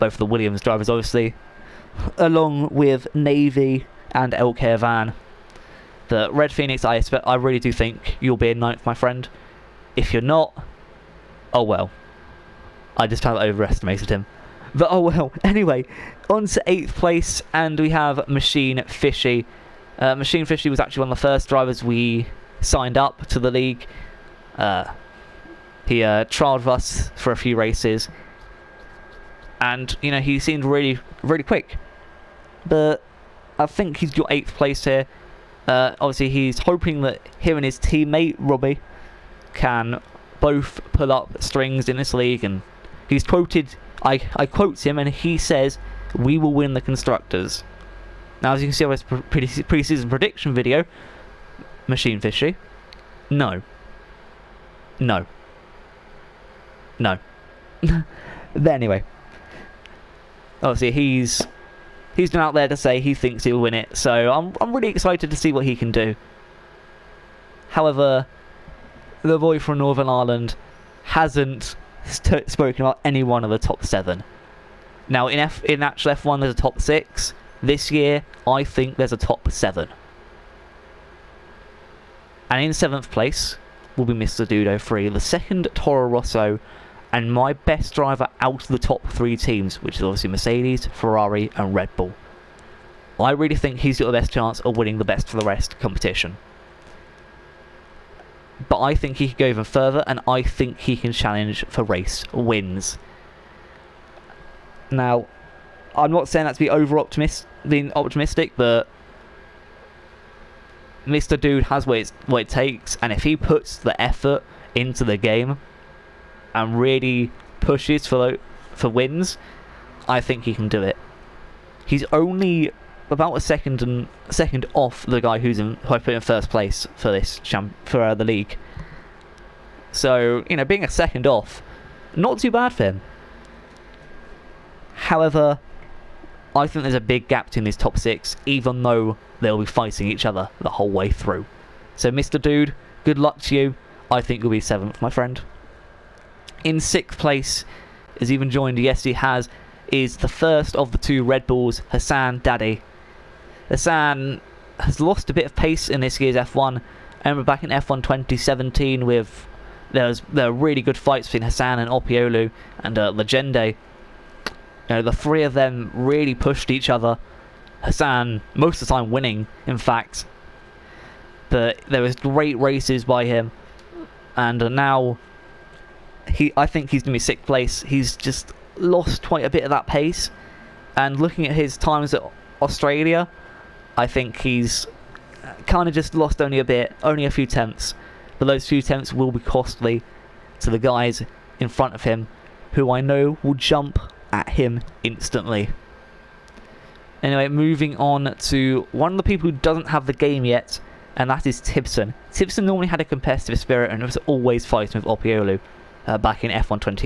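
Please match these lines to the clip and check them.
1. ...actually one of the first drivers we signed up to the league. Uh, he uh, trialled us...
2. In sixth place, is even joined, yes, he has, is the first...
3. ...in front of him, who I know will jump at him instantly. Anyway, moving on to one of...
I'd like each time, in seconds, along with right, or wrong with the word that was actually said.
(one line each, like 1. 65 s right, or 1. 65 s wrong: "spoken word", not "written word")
1. 20 s right
2. 146 s right
3. 191 s right.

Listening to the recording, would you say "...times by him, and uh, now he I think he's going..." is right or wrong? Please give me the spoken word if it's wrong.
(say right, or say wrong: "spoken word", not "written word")
wrong: "races", not "times".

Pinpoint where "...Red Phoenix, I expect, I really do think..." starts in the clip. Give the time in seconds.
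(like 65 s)
6 s.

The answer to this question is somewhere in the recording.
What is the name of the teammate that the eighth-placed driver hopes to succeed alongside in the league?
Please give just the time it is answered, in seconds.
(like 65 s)
38 s.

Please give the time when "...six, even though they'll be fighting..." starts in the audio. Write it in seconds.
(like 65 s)
137 s.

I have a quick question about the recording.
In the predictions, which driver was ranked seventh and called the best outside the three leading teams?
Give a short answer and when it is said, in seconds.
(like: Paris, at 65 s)
Mr. Dudo Free, at 84 s.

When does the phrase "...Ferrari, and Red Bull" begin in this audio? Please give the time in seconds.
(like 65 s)
90 s.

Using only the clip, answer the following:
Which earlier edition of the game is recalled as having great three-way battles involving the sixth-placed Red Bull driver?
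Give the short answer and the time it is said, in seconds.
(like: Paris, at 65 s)
F1 2017, at 157 s.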